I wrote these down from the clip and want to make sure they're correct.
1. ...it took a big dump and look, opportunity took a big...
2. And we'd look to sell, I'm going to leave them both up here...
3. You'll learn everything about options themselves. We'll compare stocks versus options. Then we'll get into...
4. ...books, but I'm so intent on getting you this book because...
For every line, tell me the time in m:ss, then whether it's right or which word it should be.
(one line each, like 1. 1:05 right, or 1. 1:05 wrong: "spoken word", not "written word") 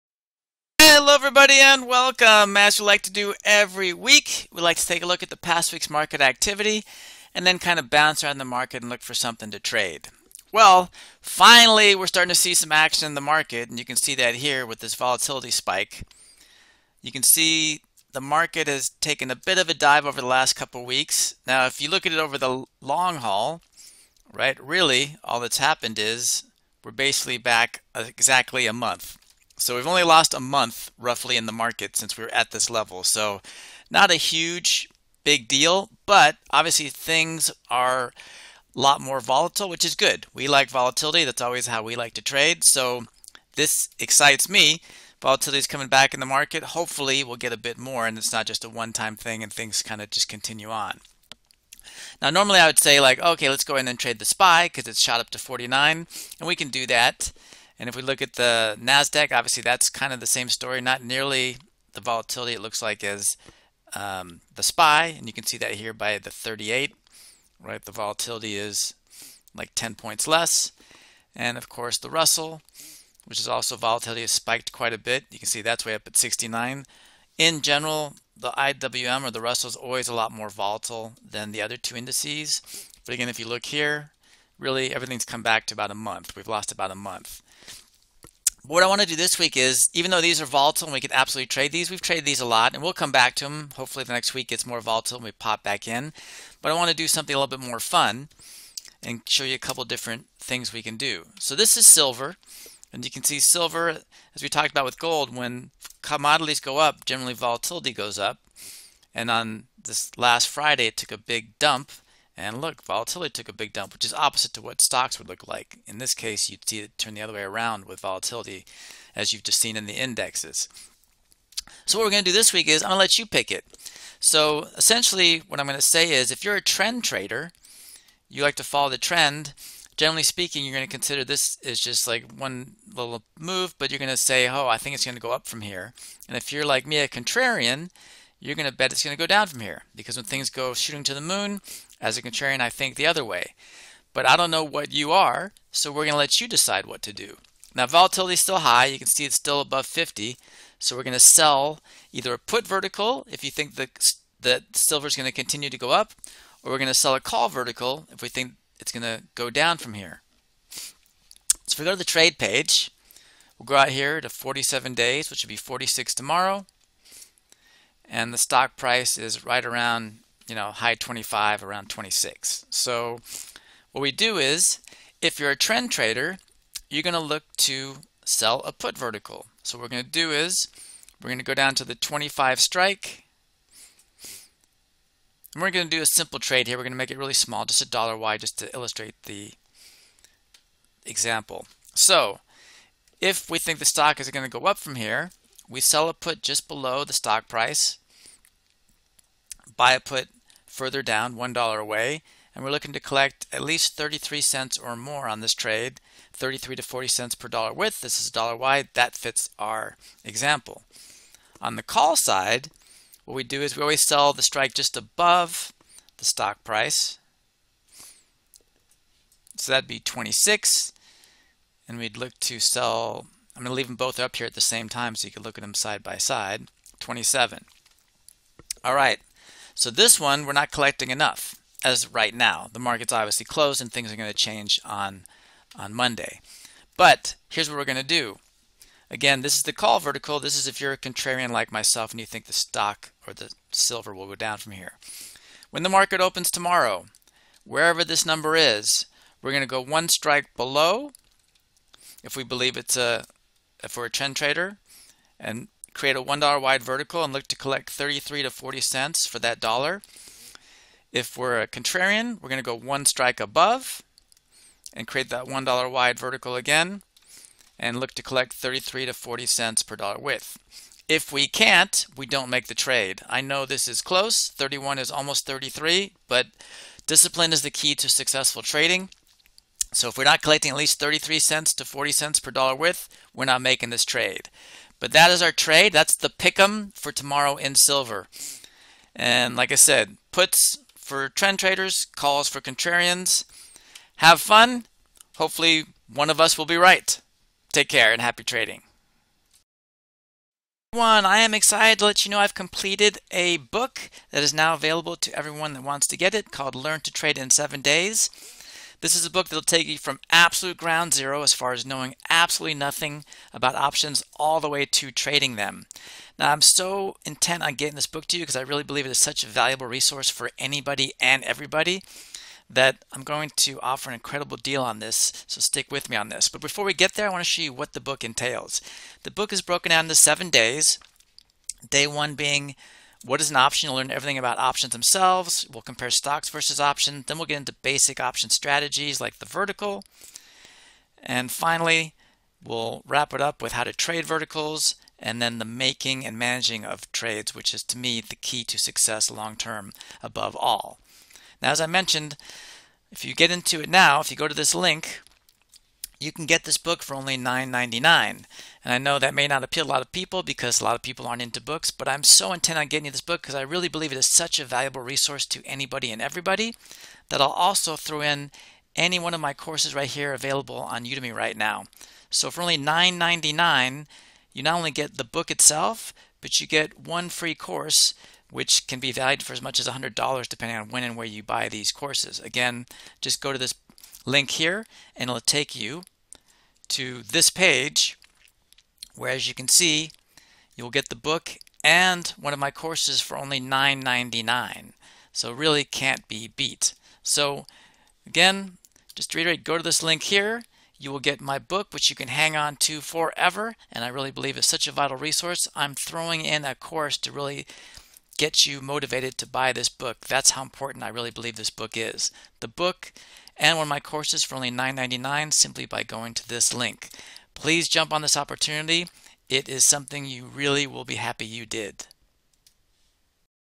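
1. 1:50 wrong: "volatility", not "opportunity"
2. 3:41 right
3. 5:33 right
4. 6:01 right.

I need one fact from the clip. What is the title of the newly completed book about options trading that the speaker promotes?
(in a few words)
Learn to Trade in 7 Days.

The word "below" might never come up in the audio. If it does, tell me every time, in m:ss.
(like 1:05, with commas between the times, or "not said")
3:16, 4:10.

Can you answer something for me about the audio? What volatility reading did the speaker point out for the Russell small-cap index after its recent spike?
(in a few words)
69.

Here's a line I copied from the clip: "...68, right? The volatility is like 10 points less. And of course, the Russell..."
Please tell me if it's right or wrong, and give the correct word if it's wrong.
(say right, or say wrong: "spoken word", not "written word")
wrong: "38", not "68".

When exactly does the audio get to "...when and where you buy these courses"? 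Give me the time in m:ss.
6:20.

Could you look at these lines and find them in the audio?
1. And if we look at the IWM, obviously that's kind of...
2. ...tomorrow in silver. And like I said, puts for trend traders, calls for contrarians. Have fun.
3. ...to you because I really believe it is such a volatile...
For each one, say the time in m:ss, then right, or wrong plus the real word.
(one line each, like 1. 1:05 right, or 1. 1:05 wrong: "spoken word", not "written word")
1. 0:57 wrong: "NASDAQ", not "IWM"
2. 4:47 right
3. 5:18 wrong: "valuable", not "volatile".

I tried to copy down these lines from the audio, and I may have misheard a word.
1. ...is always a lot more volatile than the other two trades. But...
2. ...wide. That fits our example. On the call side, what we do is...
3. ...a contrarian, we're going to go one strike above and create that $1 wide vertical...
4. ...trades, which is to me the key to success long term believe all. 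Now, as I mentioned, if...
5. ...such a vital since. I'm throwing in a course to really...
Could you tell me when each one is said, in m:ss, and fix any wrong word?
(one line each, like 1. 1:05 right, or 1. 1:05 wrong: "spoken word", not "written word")
1. 1:19 wrong: "indices", not "trades"
2. 3:28 right
3. 4:21 right
4. 5:47 wrong: "above", not "believe"
5. 6:44 wrong: "resource", not "since".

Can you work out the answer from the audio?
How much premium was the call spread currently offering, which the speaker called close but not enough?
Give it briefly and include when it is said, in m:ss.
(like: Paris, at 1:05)
31 cents, at 4:34.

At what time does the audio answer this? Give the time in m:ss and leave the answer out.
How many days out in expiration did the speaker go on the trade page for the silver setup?
2:44.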